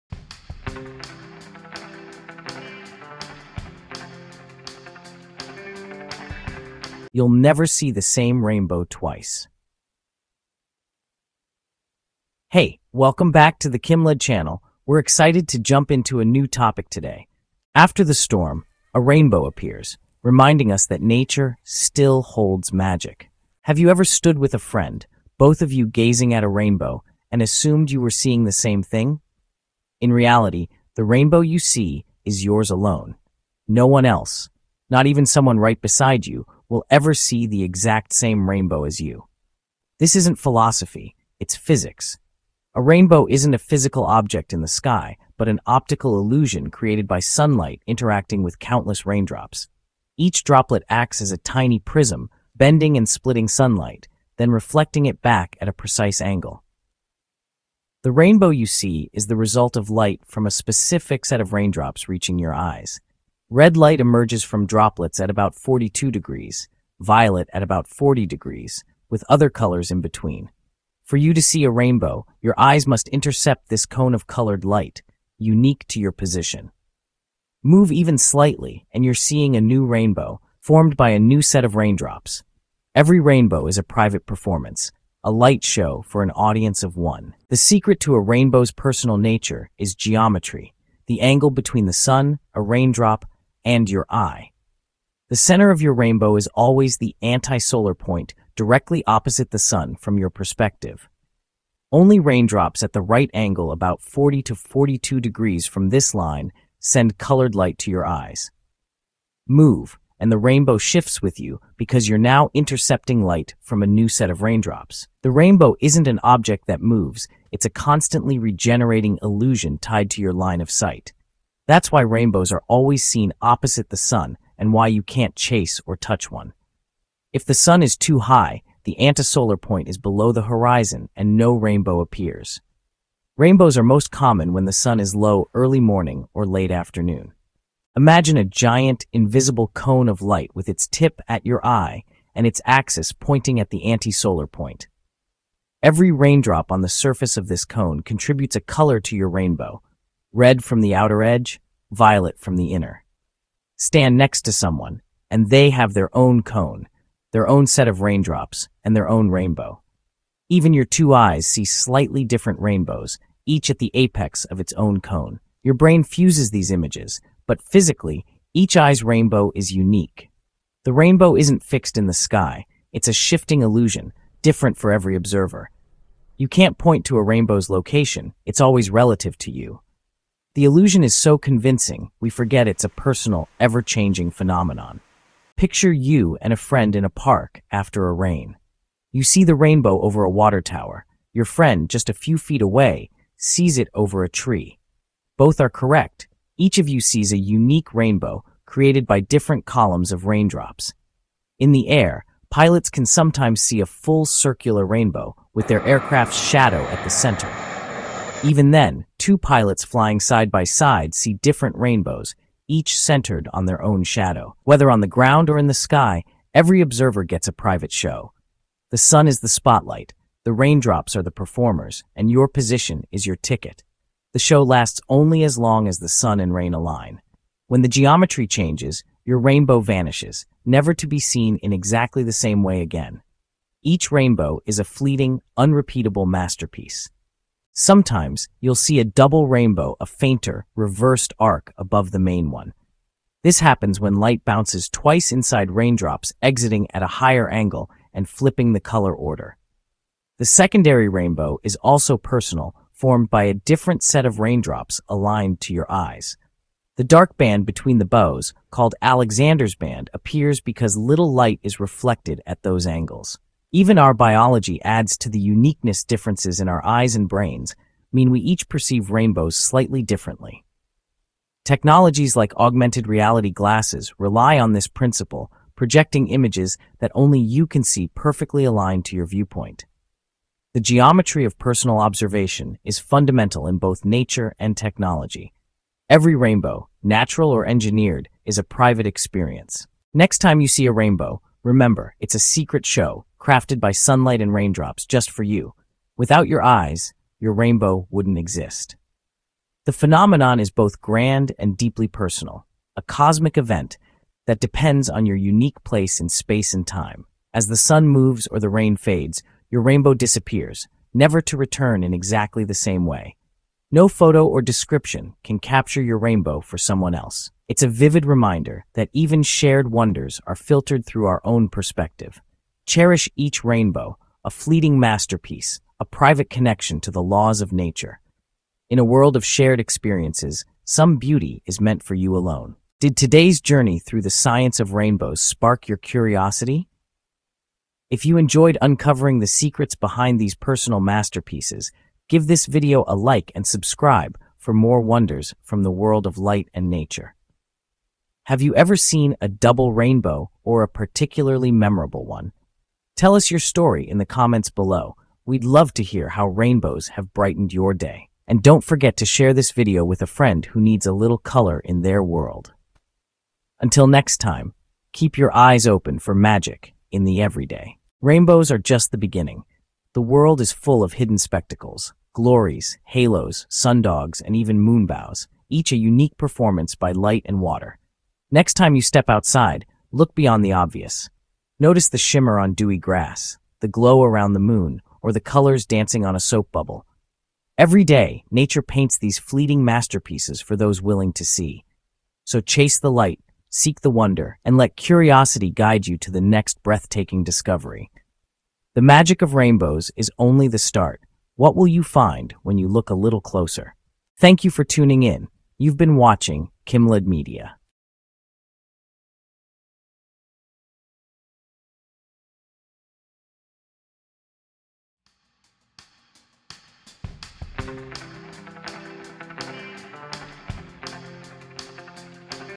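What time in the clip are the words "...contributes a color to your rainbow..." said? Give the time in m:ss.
2:28.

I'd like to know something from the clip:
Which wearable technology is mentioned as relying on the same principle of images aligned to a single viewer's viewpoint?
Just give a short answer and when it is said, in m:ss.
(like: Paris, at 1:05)
augmented reality glasses, at 4:32.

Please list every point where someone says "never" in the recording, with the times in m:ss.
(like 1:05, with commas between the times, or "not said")
0:07, 3:50, 5:11.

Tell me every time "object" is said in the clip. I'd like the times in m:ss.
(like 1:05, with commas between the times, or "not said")
0:44, 1:56.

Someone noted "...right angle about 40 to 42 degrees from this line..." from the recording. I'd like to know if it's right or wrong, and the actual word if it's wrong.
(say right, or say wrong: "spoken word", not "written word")
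right.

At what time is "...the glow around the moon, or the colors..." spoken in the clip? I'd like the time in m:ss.
6:23.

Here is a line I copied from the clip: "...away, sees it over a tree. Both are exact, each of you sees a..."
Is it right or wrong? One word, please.
wrong.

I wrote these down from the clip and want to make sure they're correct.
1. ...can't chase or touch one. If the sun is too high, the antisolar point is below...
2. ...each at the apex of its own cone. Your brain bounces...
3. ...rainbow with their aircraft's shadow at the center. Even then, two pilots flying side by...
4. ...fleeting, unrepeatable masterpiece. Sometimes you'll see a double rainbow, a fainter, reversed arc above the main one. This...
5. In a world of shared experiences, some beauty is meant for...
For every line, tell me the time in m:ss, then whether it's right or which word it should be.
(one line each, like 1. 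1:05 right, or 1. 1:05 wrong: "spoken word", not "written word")
1. 2:05 right
2. 2:43 wrong: "fuses", not "bounces"
3. 3:24 right
4. 3:54 right
5. 5:28 right.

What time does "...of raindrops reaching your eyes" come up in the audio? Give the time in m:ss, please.
1:01.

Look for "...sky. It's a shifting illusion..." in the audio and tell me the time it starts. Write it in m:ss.
2:52.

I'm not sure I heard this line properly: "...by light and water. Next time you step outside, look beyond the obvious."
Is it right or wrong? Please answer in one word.
right.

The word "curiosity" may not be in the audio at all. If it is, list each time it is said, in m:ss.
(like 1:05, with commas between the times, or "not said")
5:35, 6:34.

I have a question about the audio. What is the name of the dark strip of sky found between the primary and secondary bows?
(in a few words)
Alexander's band.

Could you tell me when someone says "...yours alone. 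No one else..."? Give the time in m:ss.
0:32.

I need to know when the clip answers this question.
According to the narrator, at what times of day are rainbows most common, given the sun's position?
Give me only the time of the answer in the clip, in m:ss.
2:15.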